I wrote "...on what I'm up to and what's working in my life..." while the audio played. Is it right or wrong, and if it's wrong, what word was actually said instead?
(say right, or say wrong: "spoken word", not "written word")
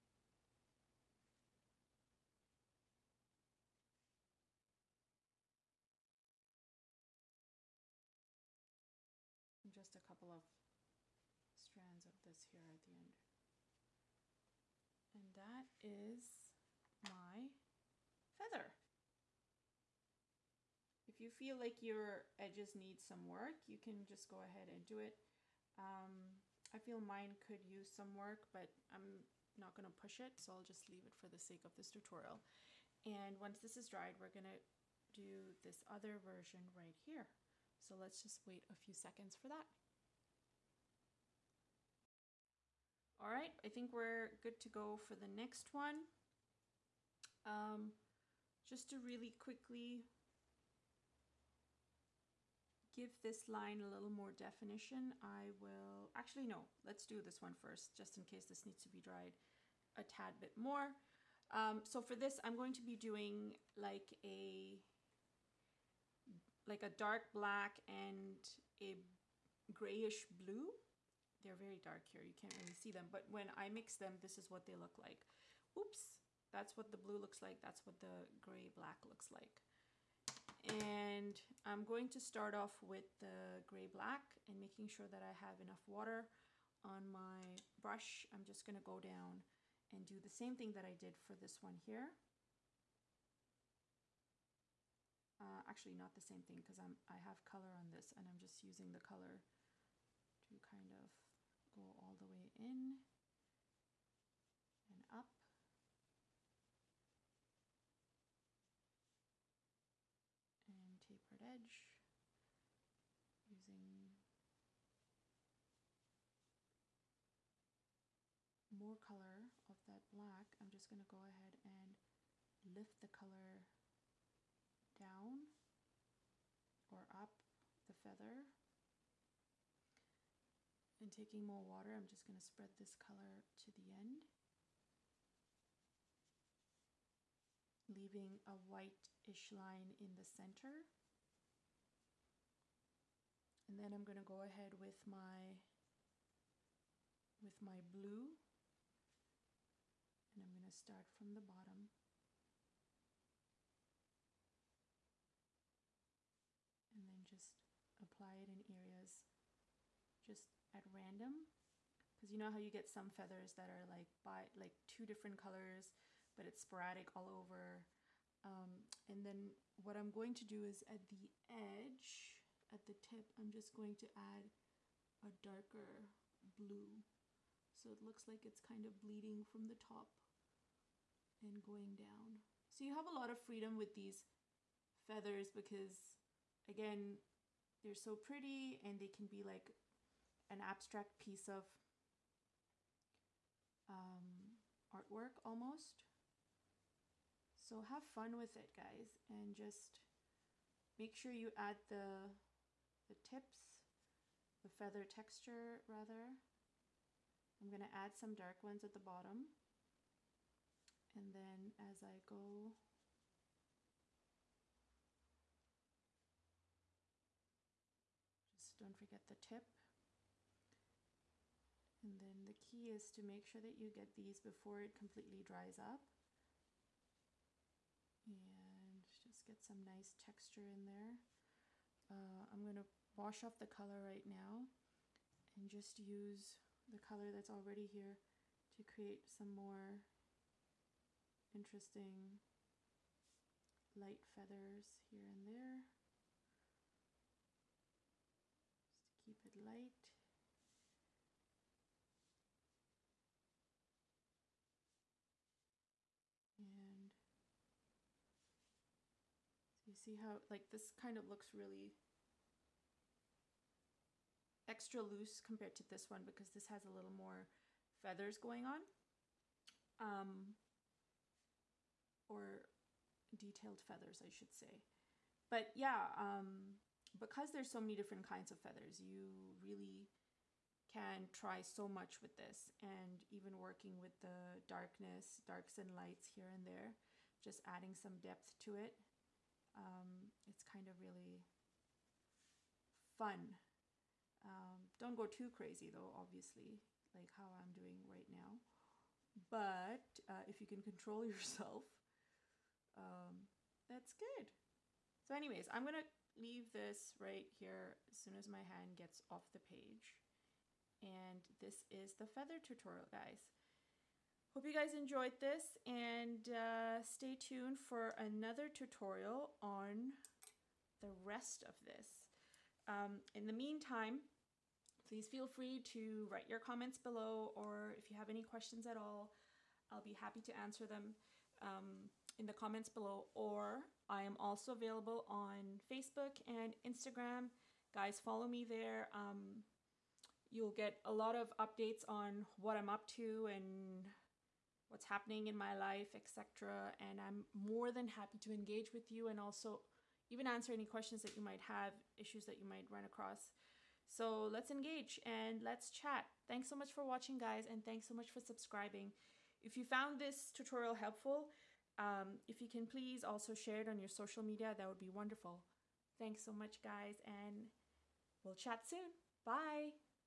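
wrong: "happening", not "working".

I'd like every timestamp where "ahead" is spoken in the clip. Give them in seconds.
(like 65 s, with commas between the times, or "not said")
24 s, 121 s, 144 s.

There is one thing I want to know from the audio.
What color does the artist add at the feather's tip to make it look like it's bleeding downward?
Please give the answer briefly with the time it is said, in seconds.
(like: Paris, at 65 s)
darker blue, at 175 s.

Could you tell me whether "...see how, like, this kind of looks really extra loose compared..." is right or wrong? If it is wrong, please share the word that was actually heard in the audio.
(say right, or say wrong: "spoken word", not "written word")
right.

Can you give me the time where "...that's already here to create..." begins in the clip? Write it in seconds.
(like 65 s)
237 s.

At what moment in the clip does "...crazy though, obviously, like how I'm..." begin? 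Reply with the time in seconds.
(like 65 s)
295 s.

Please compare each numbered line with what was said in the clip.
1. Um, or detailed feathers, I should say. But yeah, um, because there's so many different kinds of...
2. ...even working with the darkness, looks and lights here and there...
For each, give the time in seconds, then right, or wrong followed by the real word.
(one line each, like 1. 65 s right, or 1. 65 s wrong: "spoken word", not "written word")
1. 269 s right
2. 283 s wrong: "darks", not "looks".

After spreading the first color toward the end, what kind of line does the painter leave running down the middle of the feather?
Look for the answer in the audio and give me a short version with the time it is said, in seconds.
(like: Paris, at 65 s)
whitish line, at 138 s.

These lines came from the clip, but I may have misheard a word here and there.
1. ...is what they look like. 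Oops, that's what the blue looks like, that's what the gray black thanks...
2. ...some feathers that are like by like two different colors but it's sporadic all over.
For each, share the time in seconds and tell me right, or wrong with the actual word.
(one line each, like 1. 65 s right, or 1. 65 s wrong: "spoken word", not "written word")
1. 74 s wrong: "looks", not "thanks"
2. 162 s right.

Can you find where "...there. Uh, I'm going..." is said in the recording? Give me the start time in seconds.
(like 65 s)
230 s.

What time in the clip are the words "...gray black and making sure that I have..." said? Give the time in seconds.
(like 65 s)
83 s.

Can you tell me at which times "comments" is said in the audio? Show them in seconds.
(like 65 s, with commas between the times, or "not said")
326 s, 332 s.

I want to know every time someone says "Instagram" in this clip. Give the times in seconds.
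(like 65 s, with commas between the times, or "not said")
336 s.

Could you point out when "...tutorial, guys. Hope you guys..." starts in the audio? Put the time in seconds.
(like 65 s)
312 s.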